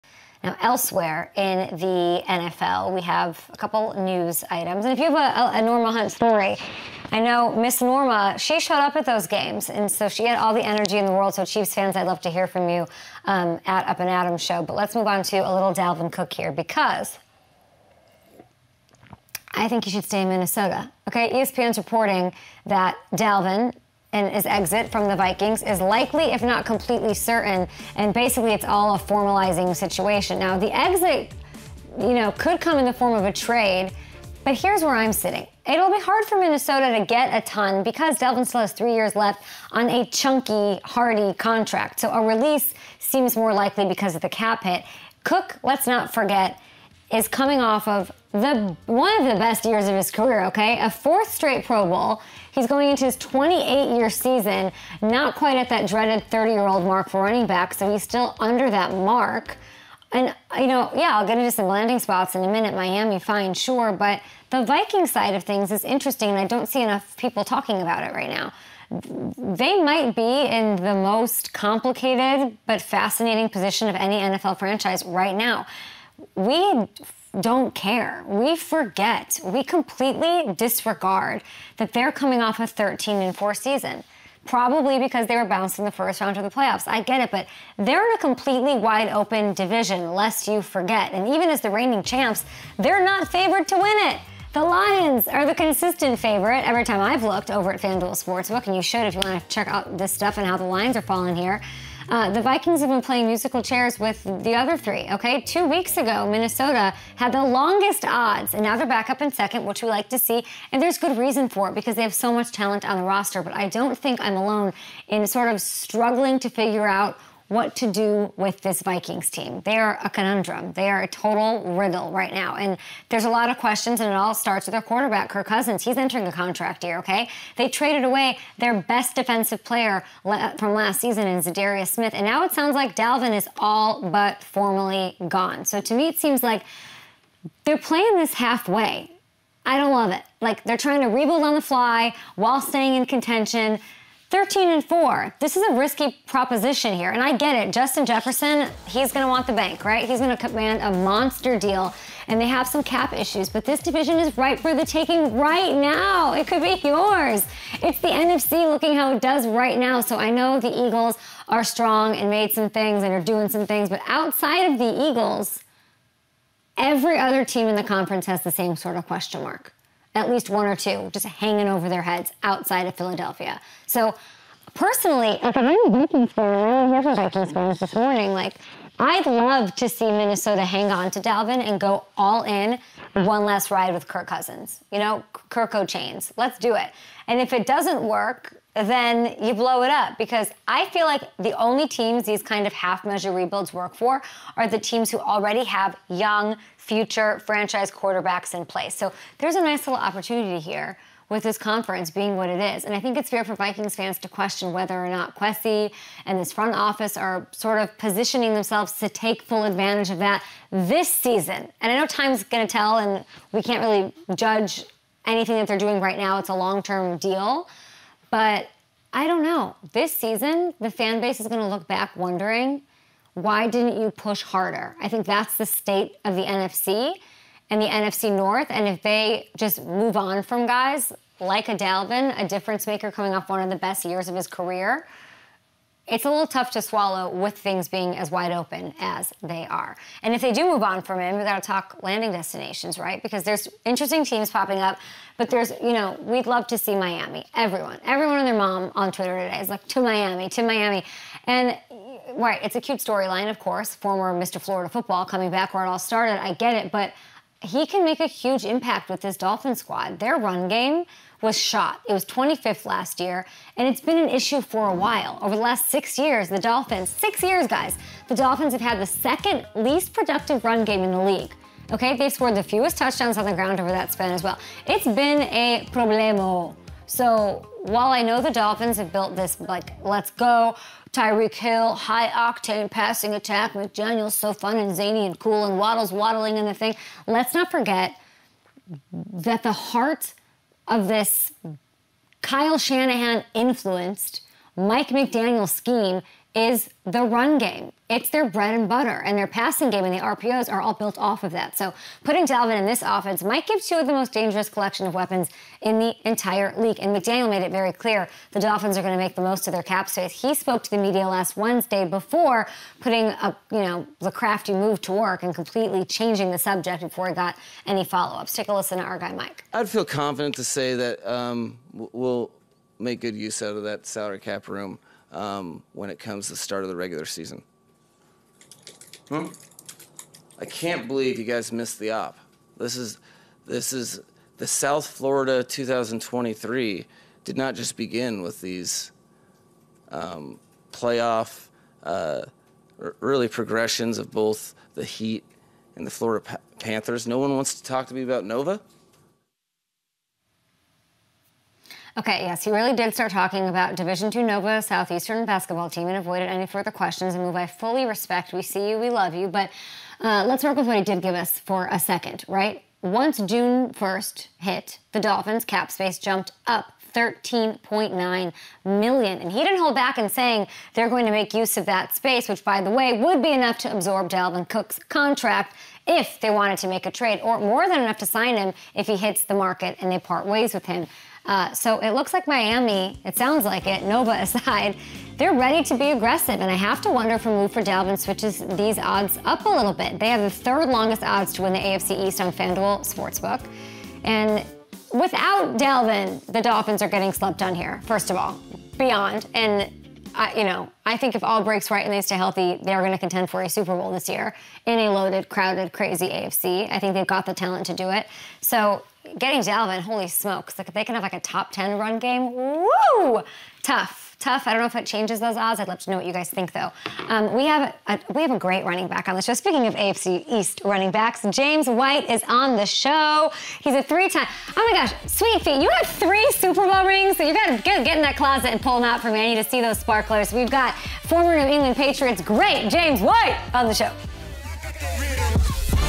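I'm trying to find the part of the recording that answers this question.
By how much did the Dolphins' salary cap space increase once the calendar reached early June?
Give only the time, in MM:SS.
06:07.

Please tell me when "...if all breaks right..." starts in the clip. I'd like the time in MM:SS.
06:41.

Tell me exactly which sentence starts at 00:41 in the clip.
So a release seems more likely because of the cap hit.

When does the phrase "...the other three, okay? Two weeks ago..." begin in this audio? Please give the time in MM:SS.
01:44.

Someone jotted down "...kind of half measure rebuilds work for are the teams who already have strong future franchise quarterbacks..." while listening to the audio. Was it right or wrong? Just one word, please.
wrong.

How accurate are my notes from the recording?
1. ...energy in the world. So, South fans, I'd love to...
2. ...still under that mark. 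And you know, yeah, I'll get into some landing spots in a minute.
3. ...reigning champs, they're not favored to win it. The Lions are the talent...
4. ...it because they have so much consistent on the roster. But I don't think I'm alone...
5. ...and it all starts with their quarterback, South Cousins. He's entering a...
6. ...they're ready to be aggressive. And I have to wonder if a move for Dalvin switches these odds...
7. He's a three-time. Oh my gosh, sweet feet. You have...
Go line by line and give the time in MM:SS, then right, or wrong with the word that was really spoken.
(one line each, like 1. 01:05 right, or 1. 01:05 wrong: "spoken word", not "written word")
1. 00:10 wrong: "Chiefs", not "South"
2. 00:58 right
3. 01:31 wrong: "consistent", not "talent"
4. 01:51 wrong: "talent", not "consistent"
5. 02:03 wrong: "Kirk", not "South"
6. 06:25 right
7. 07:03 right.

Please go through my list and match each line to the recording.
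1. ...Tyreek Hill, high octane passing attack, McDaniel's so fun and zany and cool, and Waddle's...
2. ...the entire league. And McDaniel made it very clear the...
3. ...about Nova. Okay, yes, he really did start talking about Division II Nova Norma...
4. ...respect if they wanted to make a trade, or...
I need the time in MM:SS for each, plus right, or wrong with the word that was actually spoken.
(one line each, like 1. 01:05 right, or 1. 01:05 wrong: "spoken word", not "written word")
1. 04:41 right
2. 05:05 right
3. 05:48 wrong: "Southeastern", not "Norma"
4. 06:15 wrong: "contract", not "respect".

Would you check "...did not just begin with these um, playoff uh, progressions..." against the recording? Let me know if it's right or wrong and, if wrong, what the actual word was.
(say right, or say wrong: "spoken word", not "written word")
right.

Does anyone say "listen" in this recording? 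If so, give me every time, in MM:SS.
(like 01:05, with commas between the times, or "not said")
05:18.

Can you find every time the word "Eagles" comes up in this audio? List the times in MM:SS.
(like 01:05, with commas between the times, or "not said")
02:40, 02:45.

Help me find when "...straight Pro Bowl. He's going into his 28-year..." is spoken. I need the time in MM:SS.
00:51.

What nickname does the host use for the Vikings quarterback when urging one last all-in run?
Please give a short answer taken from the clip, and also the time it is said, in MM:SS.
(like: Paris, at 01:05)
Kirko Chainz, at 03:05.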